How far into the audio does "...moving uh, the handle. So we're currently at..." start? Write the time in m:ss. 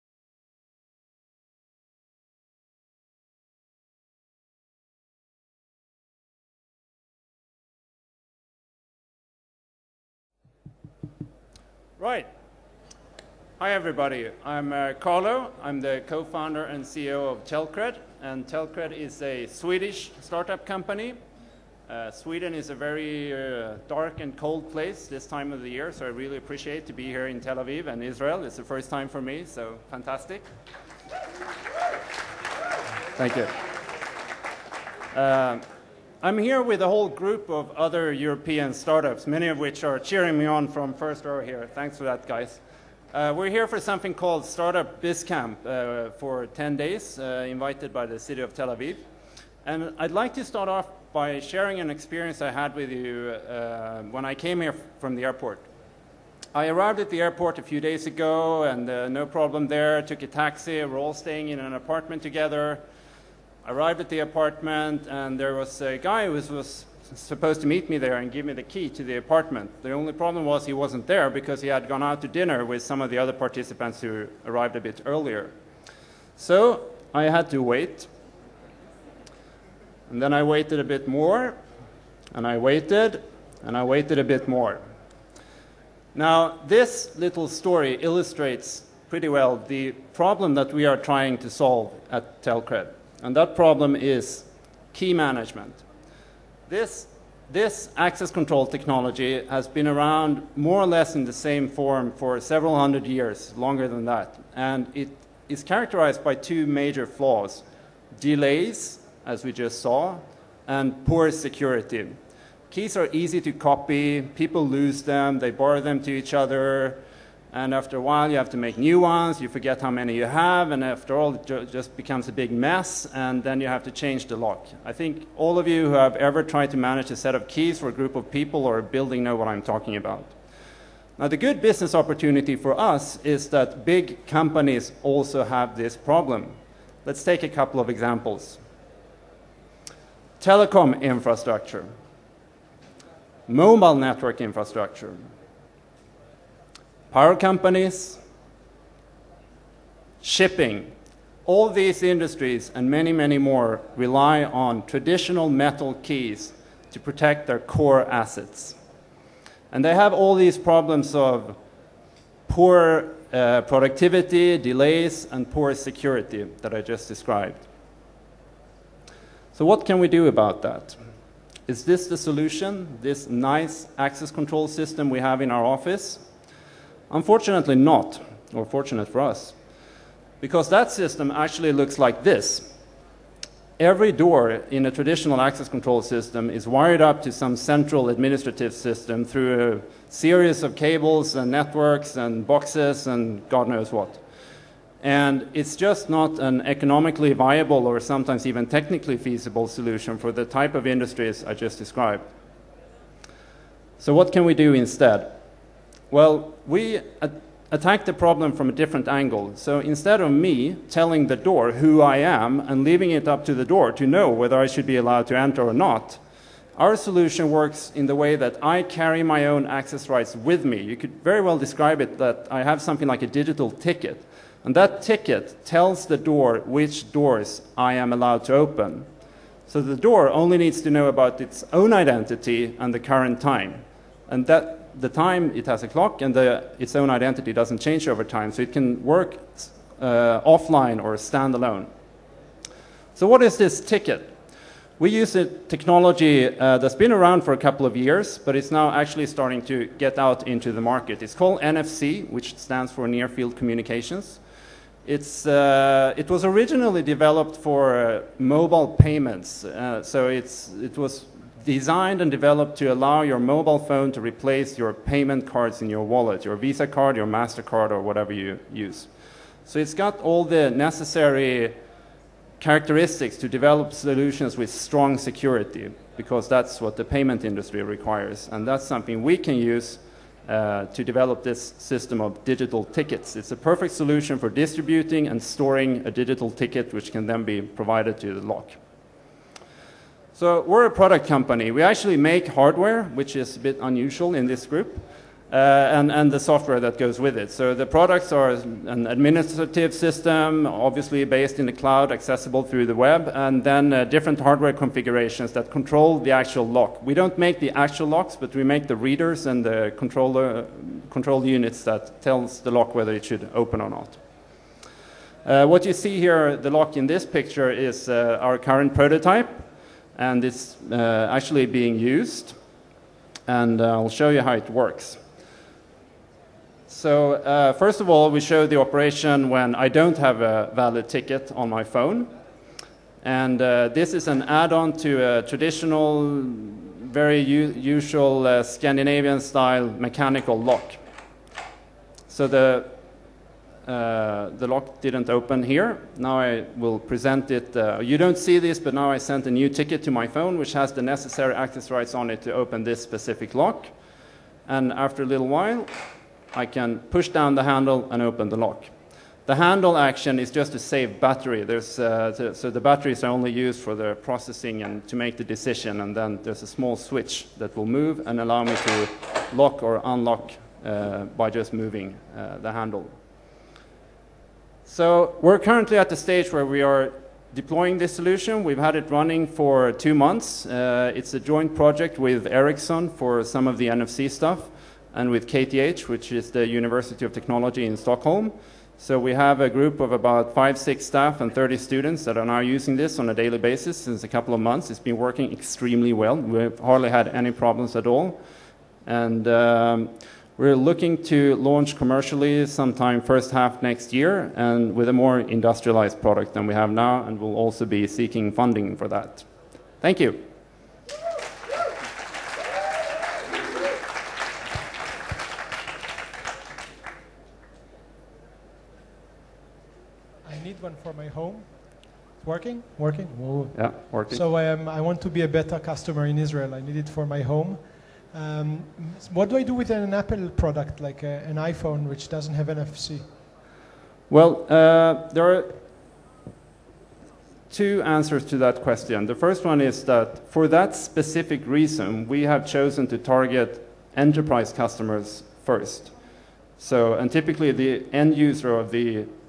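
6:11.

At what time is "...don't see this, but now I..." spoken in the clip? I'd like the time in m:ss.
5:48.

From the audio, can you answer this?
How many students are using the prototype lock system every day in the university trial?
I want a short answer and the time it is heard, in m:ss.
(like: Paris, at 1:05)
30, at 6:31.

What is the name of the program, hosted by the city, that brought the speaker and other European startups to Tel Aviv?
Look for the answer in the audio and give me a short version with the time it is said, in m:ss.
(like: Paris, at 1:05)
Startup BizCamp, at 0:44.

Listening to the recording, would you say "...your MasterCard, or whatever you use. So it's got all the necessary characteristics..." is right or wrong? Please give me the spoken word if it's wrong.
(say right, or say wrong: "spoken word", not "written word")
right.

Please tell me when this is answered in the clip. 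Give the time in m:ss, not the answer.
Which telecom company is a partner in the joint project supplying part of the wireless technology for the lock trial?
6:22.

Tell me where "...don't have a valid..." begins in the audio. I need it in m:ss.
5:29.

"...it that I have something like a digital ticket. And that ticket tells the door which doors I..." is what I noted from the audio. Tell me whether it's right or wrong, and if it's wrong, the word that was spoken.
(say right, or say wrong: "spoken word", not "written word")
right.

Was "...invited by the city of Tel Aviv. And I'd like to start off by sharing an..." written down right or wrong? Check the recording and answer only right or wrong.
right.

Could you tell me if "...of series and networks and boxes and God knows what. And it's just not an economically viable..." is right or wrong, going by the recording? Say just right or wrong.
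wrong.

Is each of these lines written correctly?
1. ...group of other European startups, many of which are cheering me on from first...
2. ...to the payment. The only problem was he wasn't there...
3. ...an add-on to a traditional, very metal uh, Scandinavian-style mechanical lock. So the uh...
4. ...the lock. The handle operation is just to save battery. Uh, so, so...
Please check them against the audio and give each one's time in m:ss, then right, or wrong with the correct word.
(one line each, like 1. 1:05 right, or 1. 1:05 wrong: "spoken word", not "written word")
1. 0:37 right
2. 1:08 wrong: "apartment", not "payment"
3. 5:34 wrong: "usual", not "metal"
4. 5:58 wrong: "action", not "operation".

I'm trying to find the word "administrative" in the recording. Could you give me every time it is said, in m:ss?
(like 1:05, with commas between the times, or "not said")
3:08, 4:59.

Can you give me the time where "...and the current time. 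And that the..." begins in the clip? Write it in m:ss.
3:52.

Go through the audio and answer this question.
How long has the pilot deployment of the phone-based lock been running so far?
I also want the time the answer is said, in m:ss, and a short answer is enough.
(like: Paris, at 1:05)
two months, at 6:19.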